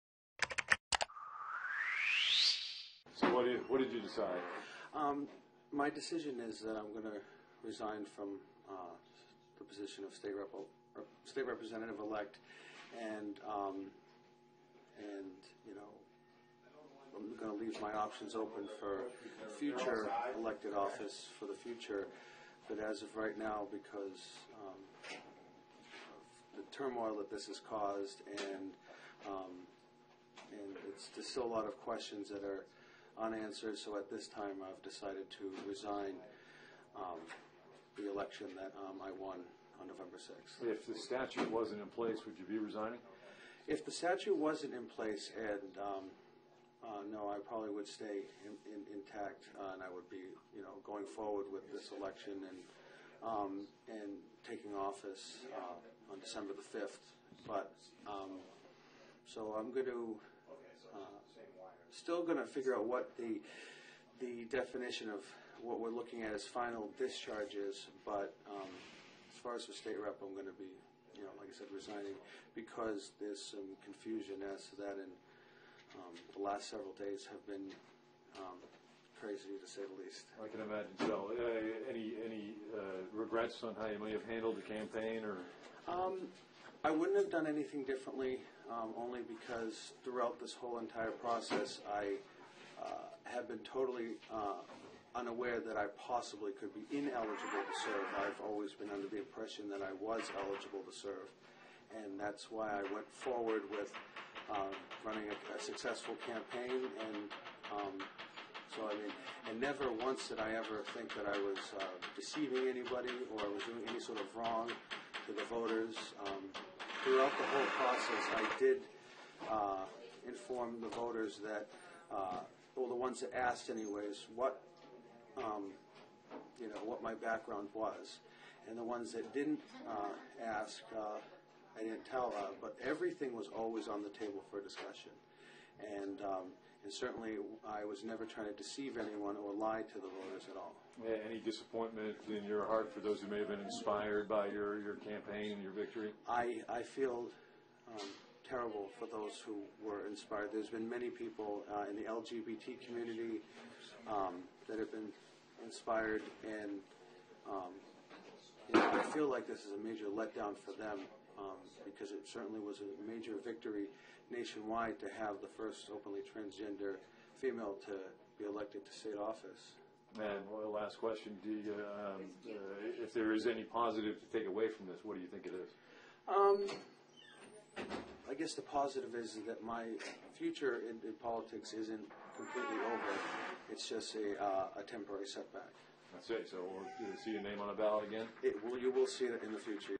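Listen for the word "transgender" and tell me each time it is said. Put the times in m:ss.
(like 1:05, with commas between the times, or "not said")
2:46.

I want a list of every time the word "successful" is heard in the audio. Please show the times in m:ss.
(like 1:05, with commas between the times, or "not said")
1:45.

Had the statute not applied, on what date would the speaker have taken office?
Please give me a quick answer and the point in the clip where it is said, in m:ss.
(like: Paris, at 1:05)
December 5, at 0:56.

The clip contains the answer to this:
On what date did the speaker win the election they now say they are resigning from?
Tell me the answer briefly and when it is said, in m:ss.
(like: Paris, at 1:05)
November 6, at 0:39.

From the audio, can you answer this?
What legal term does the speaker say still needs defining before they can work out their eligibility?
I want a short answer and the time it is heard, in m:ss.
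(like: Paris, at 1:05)
final discharge, at 1:06.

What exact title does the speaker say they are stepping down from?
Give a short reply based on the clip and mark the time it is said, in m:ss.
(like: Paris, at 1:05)
state representative elect, at 0:11.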